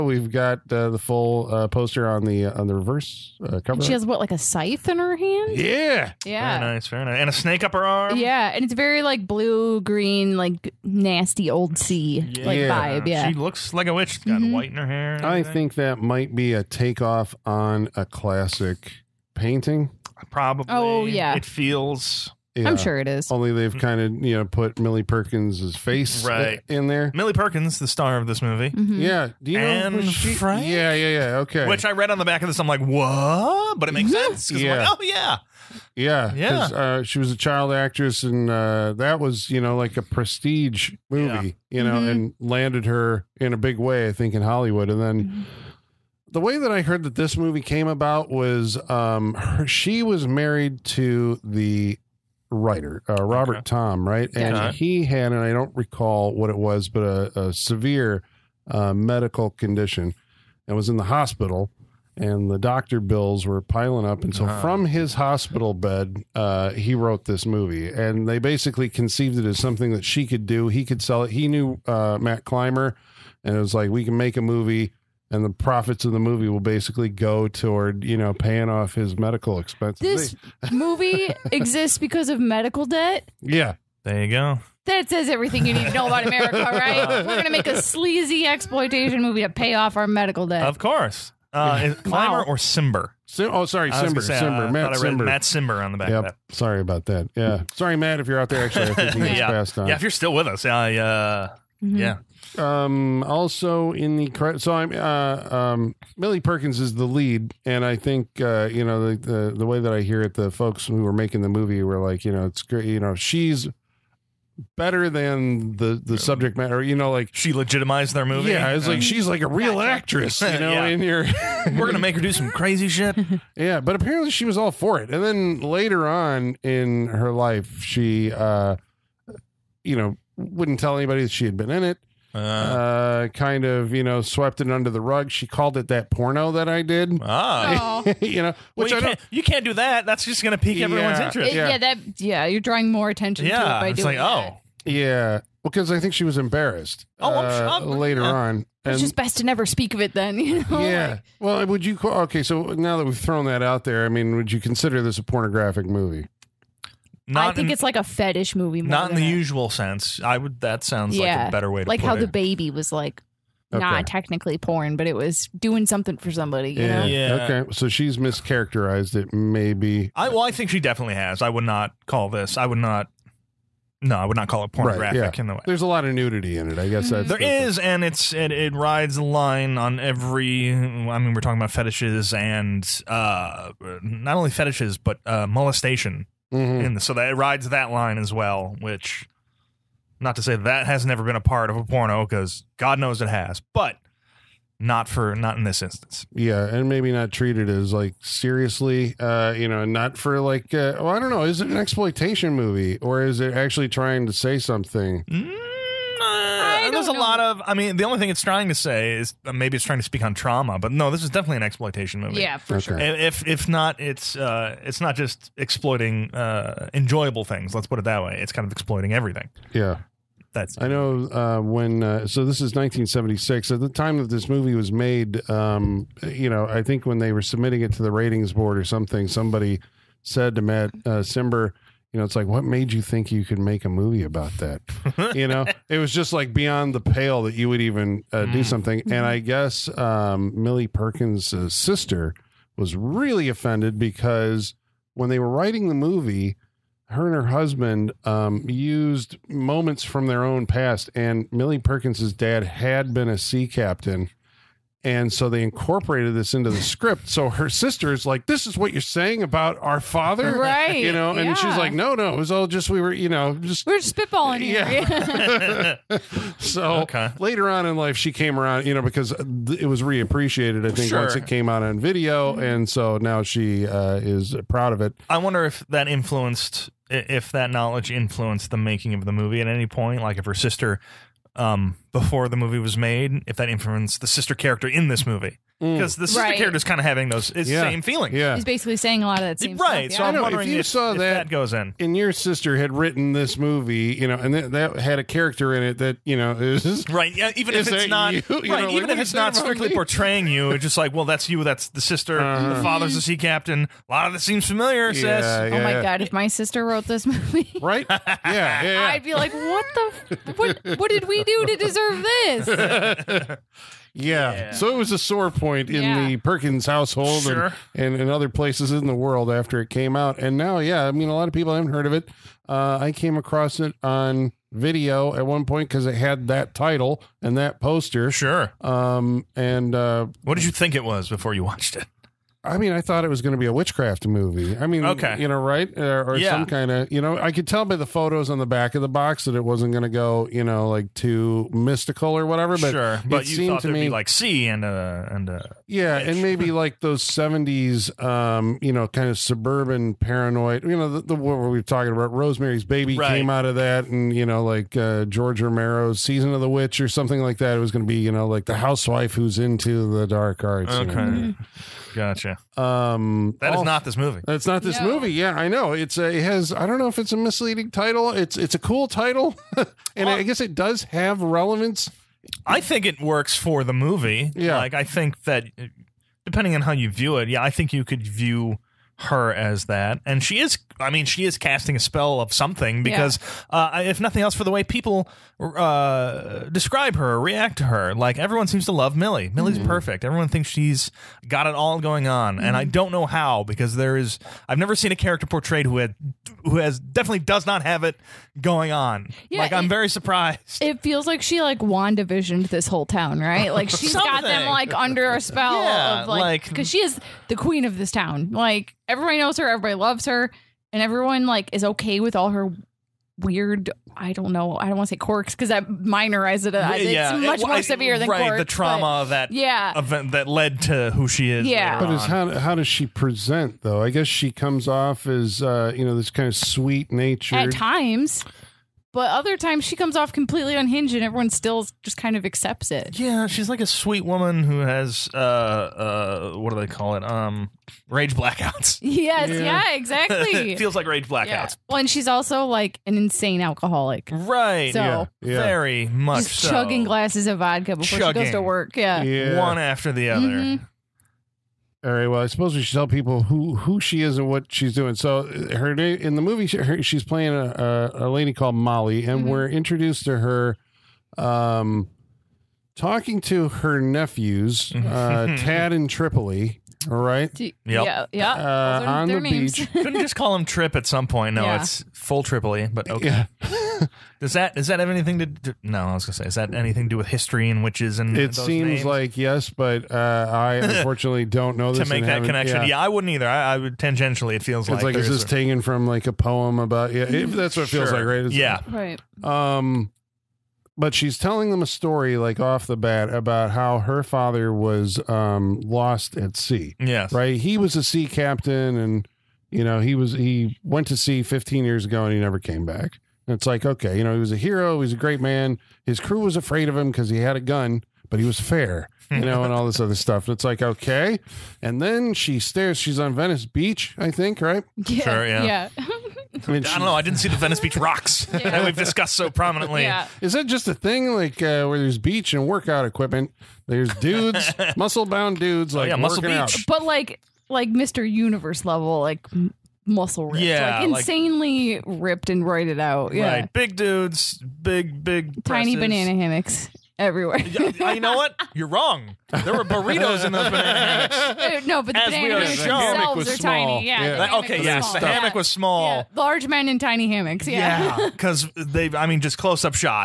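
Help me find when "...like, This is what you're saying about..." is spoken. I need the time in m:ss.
4:18.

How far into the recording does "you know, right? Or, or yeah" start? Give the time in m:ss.
5:35.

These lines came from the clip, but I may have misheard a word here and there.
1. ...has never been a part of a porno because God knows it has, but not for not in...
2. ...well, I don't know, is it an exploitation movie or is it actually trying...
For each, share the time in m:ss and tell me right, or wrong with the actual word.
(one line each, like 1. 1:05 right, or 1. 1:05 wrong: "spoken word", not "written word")
1. 3:10 right
2. 3:20 right.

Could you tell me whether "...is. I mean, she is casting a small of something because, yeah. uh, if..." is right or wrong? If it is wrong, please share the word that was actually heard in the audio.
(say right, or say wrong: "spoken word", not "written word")
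wrong: "spell", not "small".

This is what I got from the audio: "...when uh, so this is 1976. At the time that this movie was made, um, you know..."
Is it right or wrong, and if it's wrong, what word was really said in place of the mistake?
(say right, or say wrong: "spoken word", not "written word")
right.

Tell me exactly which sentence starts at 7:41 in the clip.
Um, talking to her nephews, uh, mm-hmm.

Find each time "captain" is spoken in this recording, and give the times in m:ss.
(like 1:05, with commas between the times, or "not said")
4:13, 5:03, 8:18.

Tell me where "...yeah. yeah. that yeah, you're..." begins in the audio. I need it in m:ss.
2:21.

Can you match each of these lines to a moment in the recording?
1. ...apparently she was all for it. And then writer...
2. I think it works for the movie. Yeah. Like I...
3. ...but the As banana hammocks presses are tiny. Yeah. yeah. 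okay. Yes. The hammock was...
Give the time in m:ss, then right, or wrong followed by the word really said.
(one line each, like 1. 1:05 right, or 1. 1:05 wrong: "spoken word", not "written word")
1. 2:03 wrong: "later", not "writer"
2. 6:12 right
3. 9:02 wrong: "themselves", not "presses".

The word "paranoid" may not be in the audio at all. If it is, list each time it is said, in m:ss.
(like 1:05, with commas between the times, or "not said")
5:50.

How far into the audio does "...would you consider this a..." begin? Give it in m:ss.
2:34.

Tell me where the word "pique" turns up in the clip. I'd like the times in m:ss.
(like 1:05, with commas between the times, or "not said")
2:20.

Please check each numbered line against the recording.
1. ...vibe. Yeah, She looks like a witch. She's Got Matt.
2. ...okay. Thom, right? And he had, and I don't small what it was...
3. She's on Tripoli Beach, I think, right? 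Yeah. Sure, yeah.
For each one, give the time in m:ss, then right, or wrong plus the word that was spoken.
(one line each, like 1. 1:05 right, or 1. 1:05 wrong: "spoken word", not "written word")
1. 0:12 wrong: "Mhm", not "Matt"
2. 0:53 wrong: "recall", not "small"
3. 8:32 wrong: "Venice", not "Tripoli".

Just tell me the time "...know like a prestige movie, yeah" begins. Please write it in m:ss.
0:39.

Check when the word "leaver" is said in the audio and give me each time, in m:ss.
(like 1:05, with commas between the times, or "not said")
not said.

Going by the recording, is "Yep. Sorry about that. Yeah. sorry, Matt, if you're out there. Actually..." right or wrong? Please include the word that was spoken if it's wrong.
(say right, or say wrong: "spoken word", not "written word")
right.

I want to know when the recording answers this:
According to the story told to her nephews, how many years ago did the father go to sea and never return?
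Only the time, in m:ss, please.
8:21.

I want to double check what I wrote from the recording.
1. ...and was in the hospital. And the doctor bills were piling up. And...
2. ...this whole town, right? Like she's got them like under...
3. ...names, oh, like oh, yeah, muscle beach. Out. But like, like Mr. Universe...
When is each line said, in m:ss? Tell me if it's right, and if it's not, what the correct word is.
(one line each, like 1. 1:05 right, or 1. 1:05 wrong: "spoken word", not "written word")
1. 1:00 right
2. 6:42 right
3. 8:45 wrong: "dudes", not "names".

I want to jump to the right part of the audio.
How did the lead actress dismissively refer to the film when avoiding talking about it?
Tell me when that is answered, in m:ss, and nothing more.
2:15.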